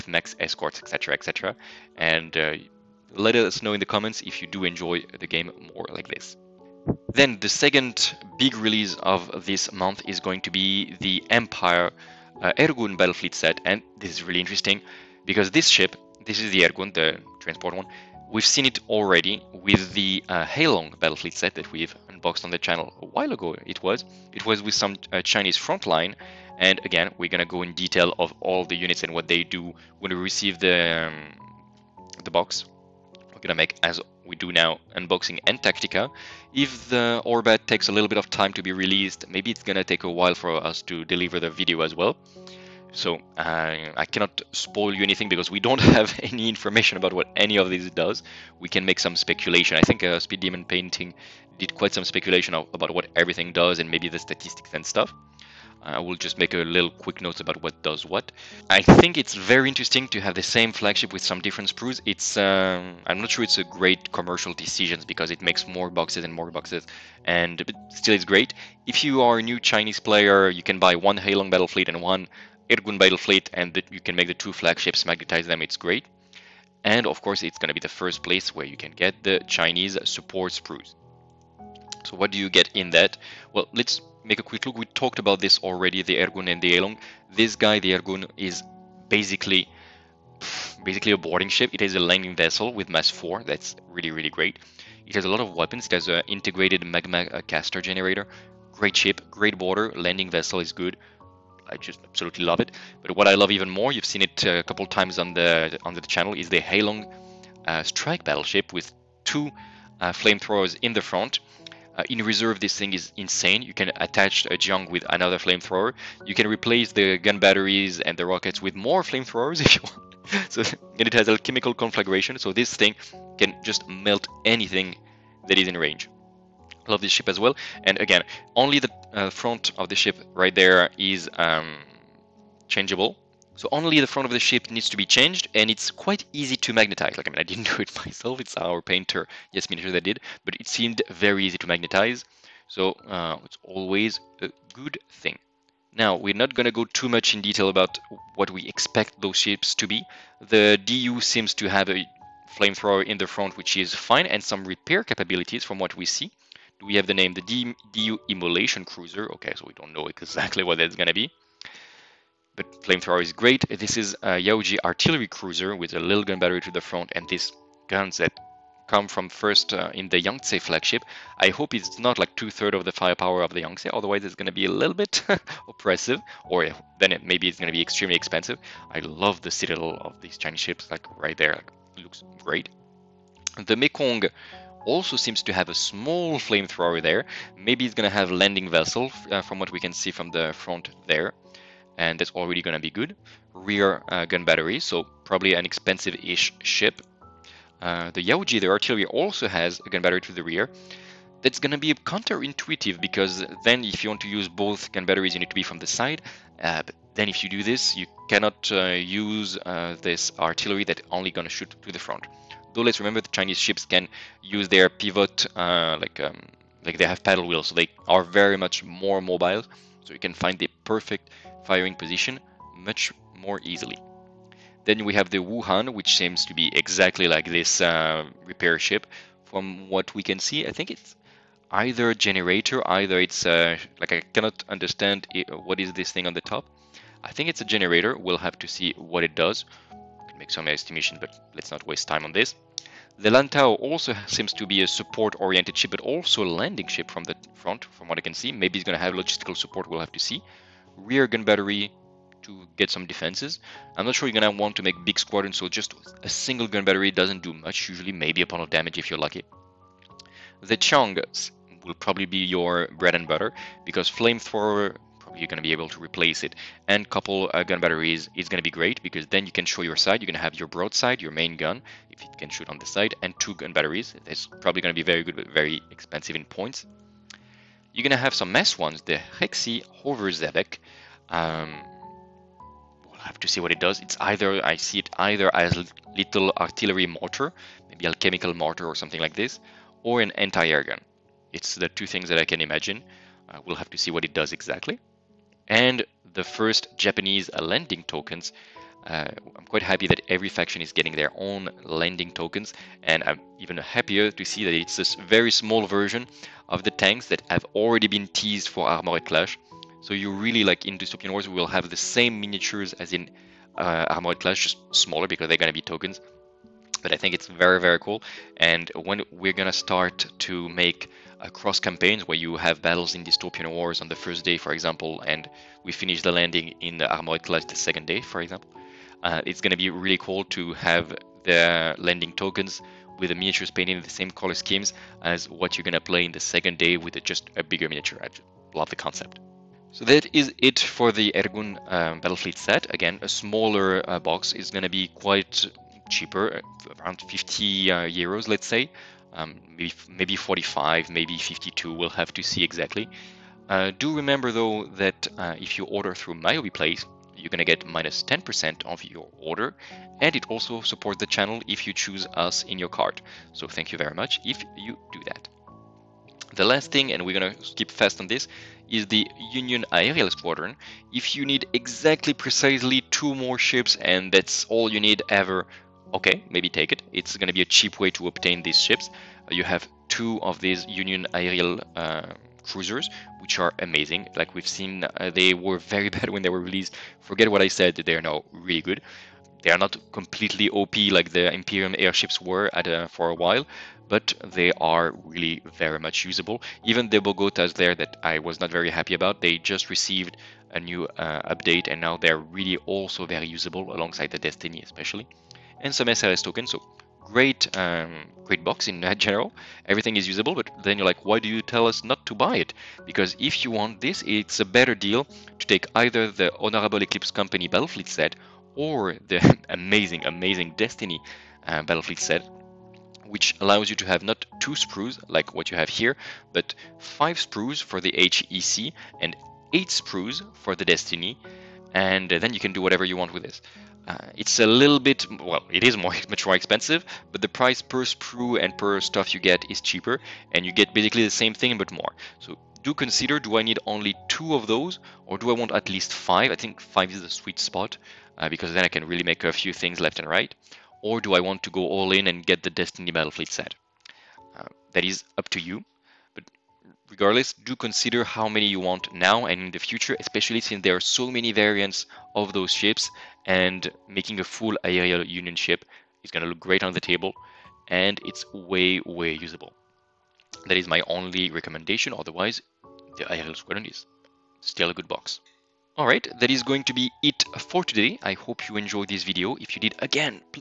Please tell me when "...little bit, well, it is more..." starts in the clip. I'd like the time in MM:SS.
07:14.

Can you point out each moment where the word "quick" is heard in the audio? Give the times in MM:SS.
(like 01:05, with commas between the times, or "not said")
00:56, 01:24.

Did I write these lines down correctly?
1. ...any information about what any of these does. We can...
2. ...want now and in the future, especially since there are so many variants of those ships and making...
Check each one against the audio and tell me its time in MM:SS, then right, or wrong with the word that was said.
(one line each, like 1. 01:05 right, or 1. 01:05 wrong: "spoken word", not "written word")
1. 00:46 right
2. 07:38 right.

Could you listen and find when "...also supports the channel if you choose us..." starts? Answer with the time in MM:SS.
06:00.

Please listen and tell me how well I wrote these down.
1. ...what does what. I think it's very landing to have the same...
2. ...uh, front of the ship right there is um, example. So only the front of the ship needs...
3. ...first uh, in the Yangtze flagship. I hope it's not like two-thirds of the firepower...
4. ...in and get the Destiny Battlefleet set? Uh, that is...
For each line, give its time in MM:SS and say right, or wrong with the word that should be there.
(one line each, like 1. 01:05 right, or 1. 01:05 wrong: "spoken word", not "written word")
1. 00:57 wrong: "interesting", not "landing"
2. 02:09 wrong: "changeable", not "example"
3. 02:49 right
4. 07:32 right.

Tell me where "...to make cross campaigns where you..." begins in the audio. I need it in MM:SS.
05:20.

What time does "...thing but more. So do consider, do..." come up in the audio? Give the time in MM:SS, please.
07:21.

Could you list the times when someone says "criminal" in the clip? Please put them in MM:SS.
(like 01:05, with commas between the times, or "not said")
not said.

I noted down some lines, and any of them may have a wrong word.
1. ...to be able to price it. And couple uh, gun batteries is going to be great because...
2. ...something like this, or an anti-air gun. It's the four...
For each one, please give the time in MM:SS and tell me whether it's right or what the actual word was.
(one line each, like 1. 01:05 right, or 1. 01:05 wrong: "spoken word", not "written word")
1. 04:25 wrong: "replace", not "price"
2. 04:48 wrong: "two", not "four".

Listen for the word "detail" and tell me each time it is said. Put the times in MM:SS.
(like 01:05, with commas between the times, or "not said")
00:27, 02:27.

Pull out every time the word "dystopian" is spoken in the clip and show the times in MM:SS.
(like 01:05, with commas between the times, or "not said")
05:10, 05:23.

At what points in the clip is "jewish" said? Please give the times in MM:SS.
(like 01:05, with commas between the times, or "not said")
not said.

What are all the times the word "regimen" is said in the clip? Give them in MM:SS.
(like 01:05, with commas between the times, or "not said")
not said.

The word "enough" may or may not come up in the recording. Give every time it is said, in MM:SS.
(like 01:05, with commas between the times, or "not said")
not said.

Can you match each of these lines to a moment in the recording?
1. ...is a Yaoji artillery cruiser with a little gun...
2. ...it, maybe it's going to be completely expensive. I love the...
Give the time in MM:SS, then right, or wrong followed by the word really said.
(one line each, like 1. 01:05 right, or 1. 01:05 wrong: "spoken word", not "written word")
1. 02:43 right
2. 02:57 wrong: "extremely", not "completely".